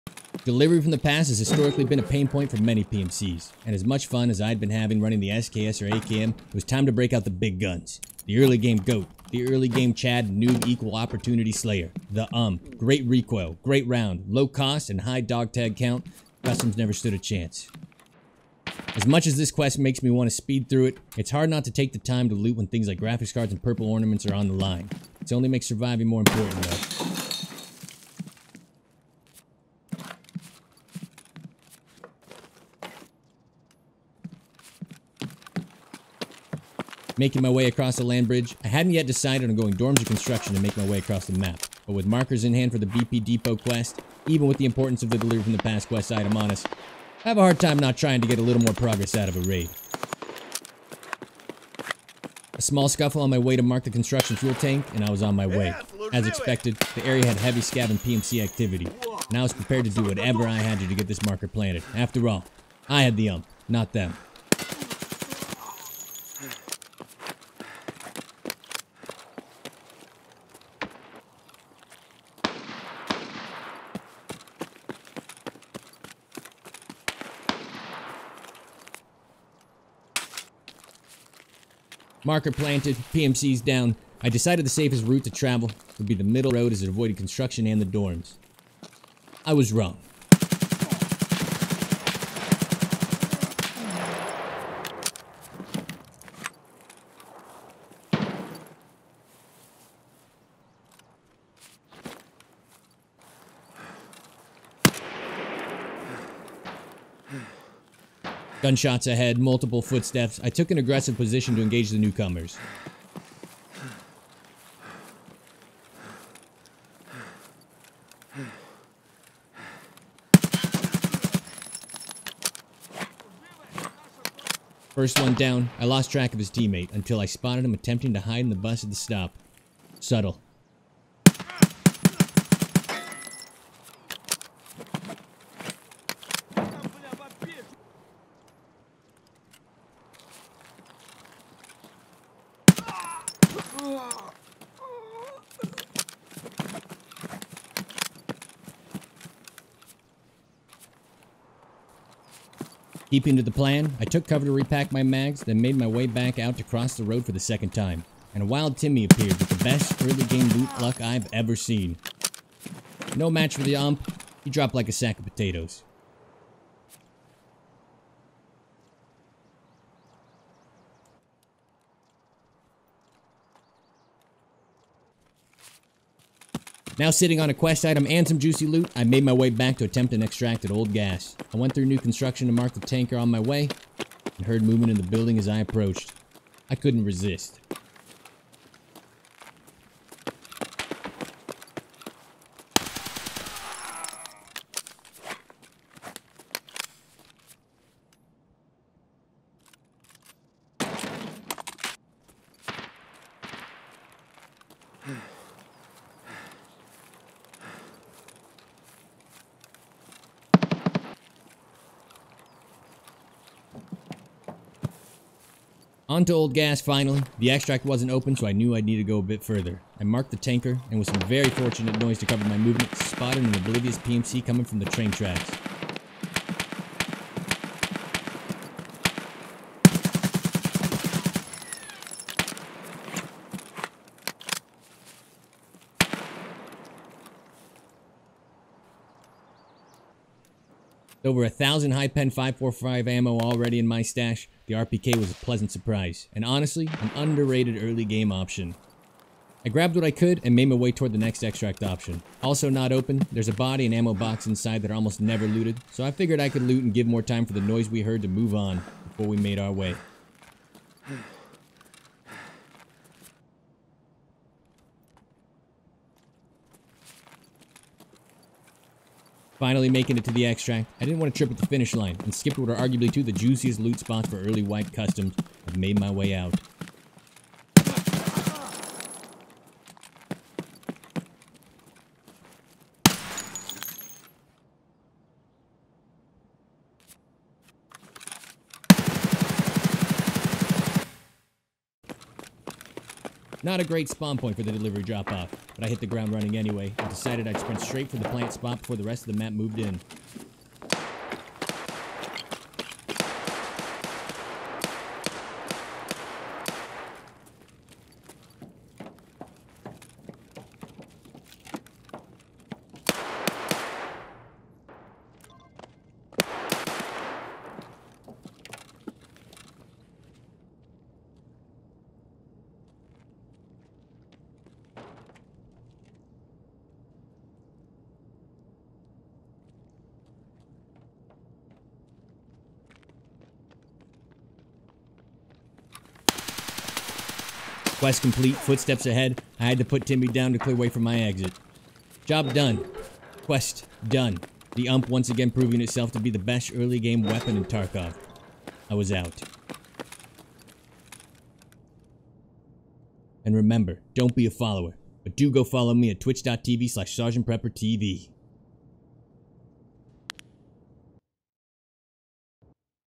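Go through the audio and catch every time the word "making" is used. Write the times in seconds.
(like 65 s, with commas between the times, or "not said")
37 s, 269 s.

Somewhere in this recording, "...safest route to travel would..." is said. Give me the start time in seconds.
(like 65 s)
84 s.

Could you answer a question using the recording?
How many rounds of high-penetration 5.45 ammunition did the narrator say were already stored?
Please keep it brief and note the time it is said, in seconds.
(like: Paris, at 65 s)
over 1000, at 241 s.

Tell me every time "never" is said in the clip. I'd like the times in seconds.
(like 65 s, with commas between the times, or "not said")
16 s, 255 s.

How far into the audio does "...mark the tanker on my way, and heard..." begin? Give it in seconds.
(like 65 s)
182 s.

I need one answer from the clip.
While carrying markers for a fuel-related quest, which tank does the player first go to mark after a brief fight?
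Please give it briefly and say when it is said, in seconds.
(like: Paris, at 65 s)
construction fuel tank, at 53 s.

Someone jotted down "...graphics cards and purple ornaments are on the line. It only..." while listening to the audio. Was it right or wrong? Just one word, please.
right.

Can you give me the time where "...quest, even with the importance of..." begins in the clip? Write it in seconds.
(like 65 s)
43 s.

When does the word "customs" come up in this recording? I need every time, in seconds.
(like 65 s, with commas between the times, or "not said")
16 s, 274 s.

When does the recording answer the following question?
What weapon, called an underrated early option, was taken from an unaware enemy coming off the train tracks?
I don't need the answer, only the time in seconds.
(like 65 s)
244 s.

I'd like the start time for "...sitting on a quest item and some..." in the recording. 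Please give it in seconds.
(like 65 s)
177 s.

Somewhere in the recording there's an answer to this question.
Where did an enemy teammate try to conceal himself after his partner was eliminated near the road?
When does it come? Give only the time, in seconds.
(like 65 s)
128 s.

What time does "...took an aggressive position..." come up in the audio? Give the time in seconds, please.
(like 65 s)
110 s.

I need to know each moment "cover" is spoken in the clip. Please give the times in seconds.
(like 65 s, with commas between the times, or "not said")
154 s, 222 s.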